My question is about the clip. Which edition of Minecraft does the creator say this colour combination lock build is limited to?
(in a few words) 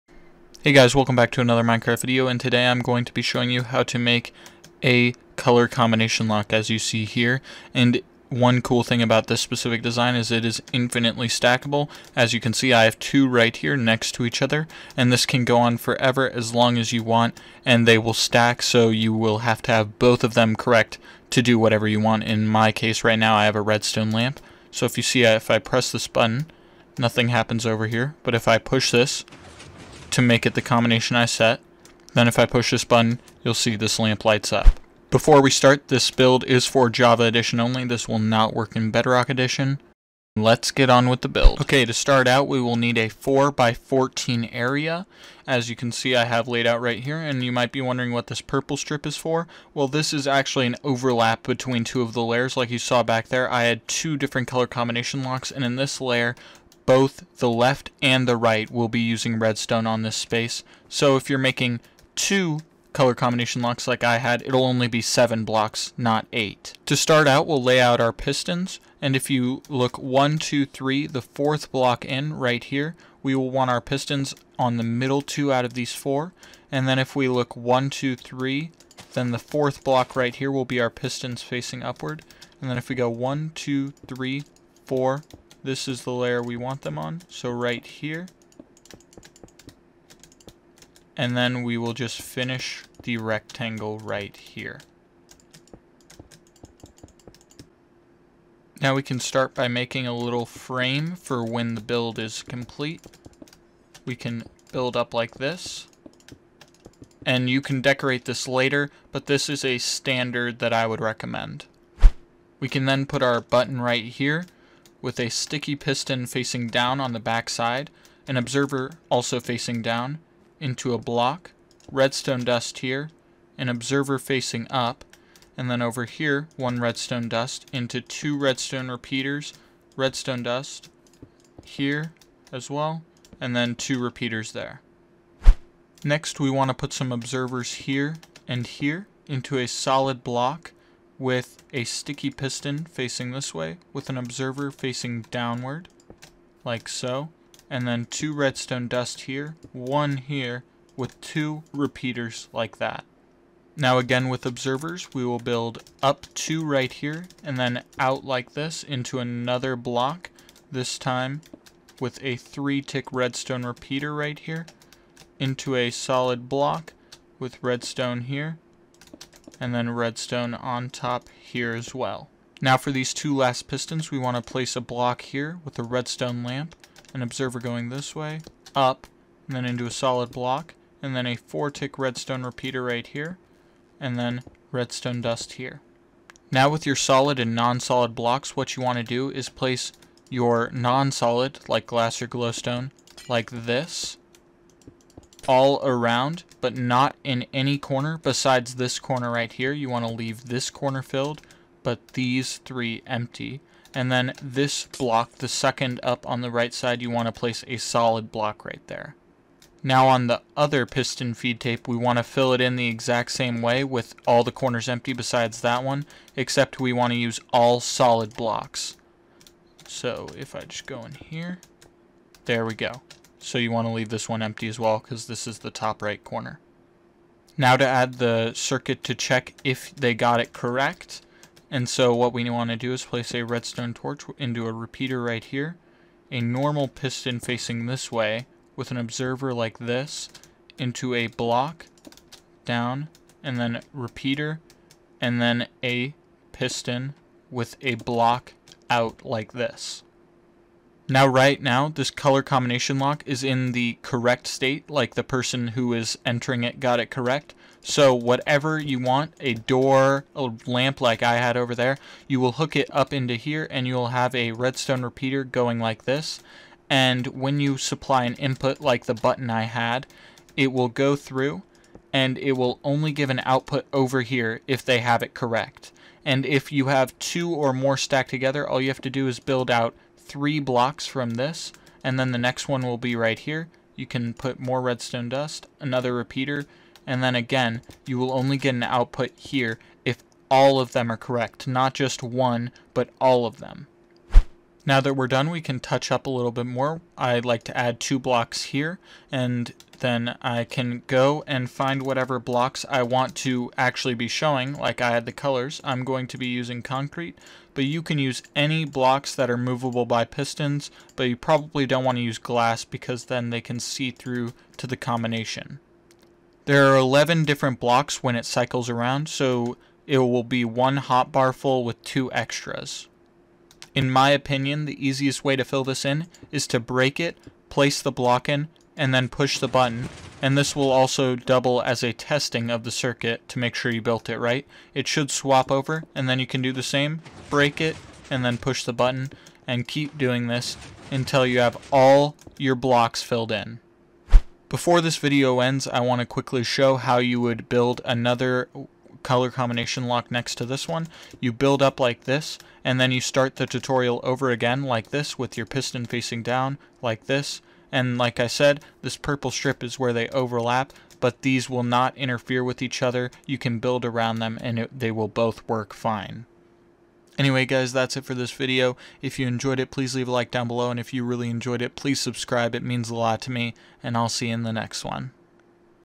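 Java Edition.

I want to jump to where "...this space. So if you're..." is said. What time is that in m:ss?
1:00.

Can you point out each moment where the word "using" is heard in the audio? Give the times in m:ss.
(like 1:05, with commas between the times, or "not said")
0:58, 5:06.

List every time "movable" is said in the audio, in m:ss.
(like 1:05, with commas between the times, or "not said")
5:09.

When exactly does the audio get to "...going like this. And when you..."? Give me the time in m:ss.
4:25.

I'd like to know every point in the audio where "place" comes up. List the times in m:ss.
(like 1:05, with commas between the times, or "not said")
2:54, 3:09, 3:27, 3:53, 5:27.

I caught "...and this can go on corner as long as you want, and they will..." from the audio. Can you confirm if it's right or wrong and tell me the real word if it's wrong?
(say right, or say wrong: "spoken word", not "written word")
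wrong: "forever", not "corner".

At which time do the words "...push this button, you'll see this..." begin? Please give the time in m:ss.
0:32.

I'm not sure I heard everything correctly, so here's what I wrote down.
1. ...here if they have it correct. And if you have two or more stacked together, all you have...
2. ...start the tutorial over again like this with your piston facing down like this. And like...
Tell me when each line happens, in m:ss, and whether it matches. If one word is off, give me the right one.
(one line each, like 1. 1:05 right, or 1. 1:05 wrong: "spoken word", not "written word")
1. 4:34 right
2. 5:53 right.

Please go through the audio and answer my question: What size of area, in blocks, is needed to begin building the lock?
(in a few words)
4 by 14.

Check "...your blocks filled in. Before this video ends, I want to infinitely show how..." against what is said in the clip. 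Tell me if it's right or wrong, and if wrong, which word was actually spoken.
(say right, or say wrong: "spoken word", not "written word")
wrong: "quickly", not "infinitely".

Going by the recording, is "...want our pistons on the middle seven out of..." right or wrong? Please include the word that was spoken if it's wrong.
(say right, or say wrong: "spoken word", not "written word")
wrong: "two", not "seven".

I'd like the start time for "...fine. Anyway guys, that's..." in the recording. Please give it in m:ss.
6:05.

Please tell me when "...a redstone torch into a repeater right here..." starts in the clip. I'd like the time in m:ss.
3:53.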